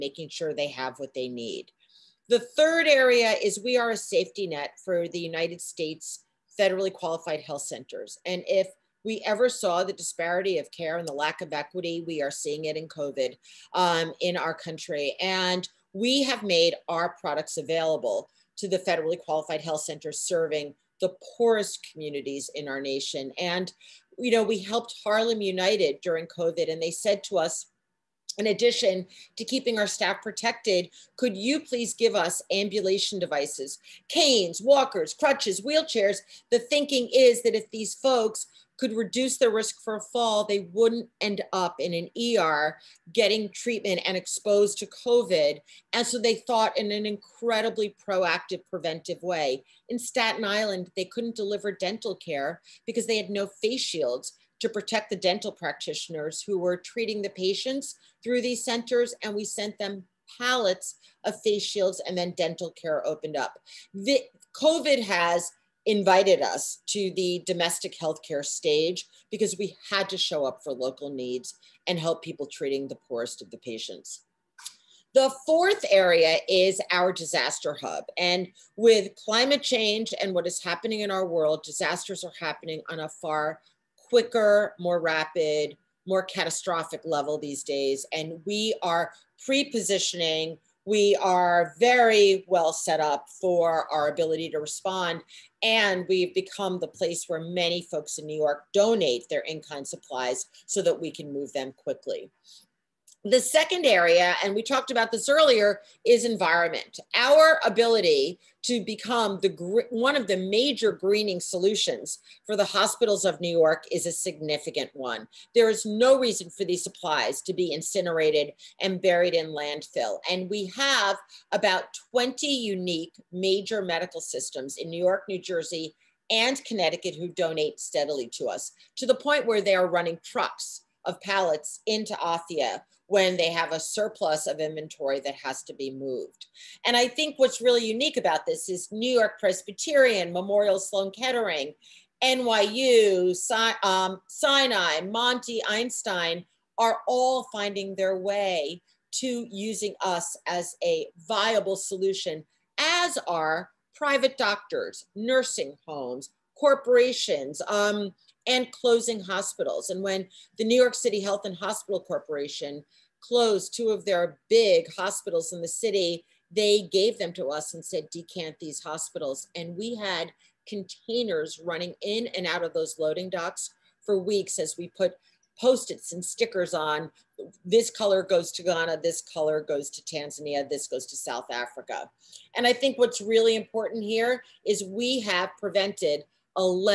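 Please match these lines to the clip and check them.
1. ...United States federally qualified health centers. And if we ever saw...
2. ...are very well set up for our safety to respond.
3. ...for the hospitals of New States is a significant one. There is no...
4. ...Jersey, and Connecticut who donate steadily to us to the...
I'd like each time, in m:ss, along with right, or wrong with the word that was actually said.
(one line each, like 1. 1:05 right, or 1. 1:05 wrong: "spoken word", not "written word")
1. 0:05 right
2. 1:31 wrong: "ability", not "safety"
3. 1:52 wrong: "York", not "States"
4. 2:05 right.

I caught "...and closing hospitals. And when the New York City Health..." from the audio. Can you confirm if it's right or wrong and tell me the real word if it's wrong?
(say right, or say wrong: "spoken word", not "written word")
right.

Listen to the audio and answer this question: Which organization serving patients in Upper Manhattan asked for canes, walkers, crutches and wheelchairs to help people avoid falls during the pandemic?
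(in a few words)
Harlem United.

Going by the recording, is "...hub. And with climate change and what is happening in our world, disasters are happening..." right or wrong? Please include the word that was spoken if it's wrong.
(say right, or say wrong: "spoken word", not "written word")
right.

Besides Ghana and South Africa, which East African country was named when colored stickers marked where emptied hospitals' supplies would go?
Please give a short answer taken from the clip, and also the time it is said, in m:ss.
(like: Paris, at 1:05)
Tanzania, at 3:00.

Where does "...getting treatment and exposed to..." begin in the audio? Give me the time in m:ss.
0:43.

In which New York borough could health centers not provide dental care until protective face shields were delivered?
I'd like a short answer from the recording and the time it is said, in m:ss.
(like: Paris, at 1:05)
Staten Island, at 0:50.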